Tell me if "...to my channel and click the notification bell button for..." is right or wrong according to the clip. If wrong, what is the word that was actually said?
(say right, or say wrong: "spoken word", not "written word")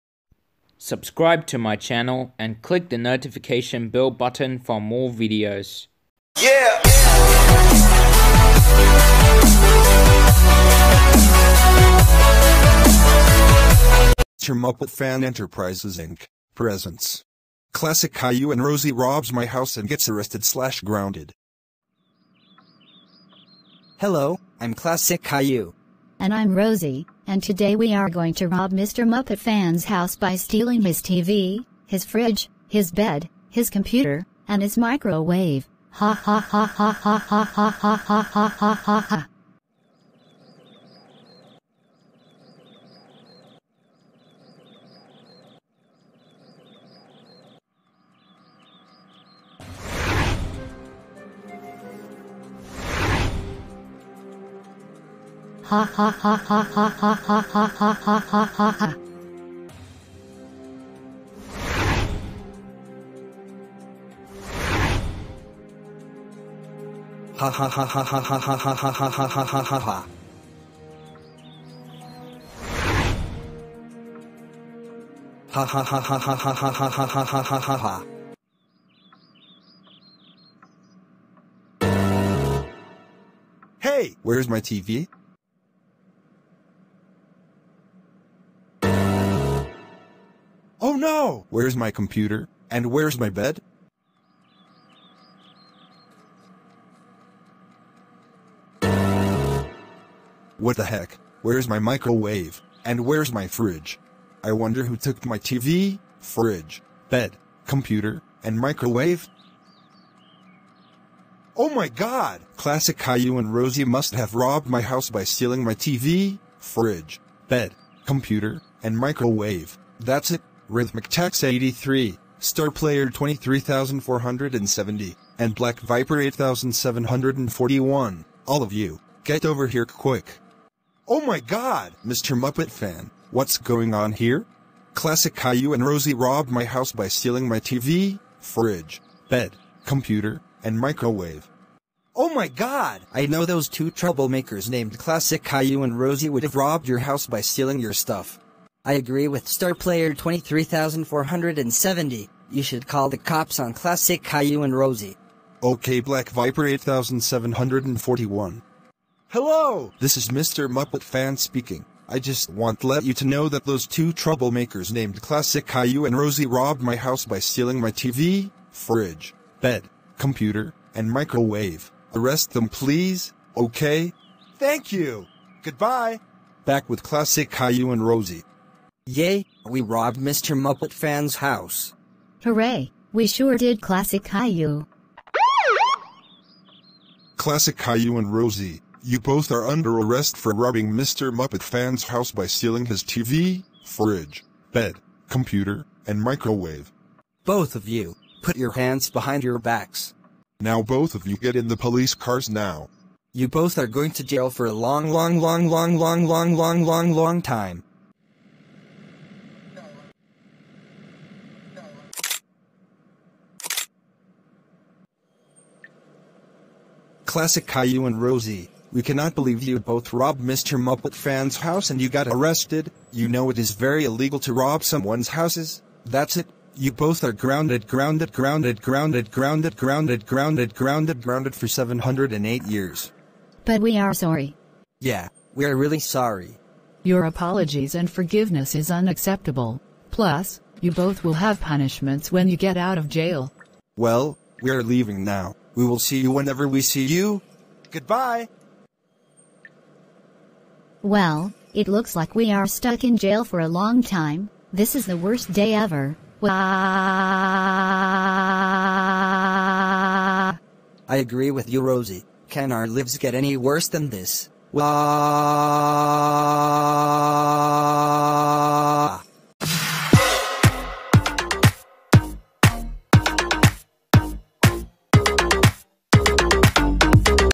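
right.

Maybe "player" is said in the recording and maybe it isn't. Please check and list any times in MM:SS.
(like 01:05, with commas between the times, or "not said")
02:02, 02:29.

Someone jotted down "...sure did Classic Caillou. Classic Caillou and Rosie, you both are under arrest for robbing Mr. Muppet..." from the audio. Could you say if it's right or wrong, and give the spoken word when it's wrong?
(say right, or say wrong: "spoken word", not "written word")
right.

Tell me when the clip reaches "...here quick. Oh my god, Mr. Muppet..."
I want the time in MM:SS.
02:09.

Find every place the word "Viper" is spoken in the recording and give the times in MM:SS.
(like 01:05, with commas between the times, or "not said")
02:05, 02:36.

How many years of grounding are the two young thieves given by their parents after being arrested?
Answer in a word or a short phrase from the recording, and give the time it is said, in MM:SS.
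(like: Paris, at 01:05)
708, at 03:51.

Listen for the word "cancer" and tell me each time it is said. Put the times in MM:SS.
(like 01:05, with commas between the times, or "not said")
not said.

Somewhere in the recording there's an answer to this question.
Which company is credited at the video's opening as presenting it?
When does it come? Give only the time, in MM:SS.
00:14.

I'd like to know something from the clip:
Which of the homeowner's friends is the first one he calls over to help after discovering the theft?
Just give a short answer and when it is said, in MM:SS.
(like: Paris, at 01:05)
Rhythmic Tax 83, at 02:00.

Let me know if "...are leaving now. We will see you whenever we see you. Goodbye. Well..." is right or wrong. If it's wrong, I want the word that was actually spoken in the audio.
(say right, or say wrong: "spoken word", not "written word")
right.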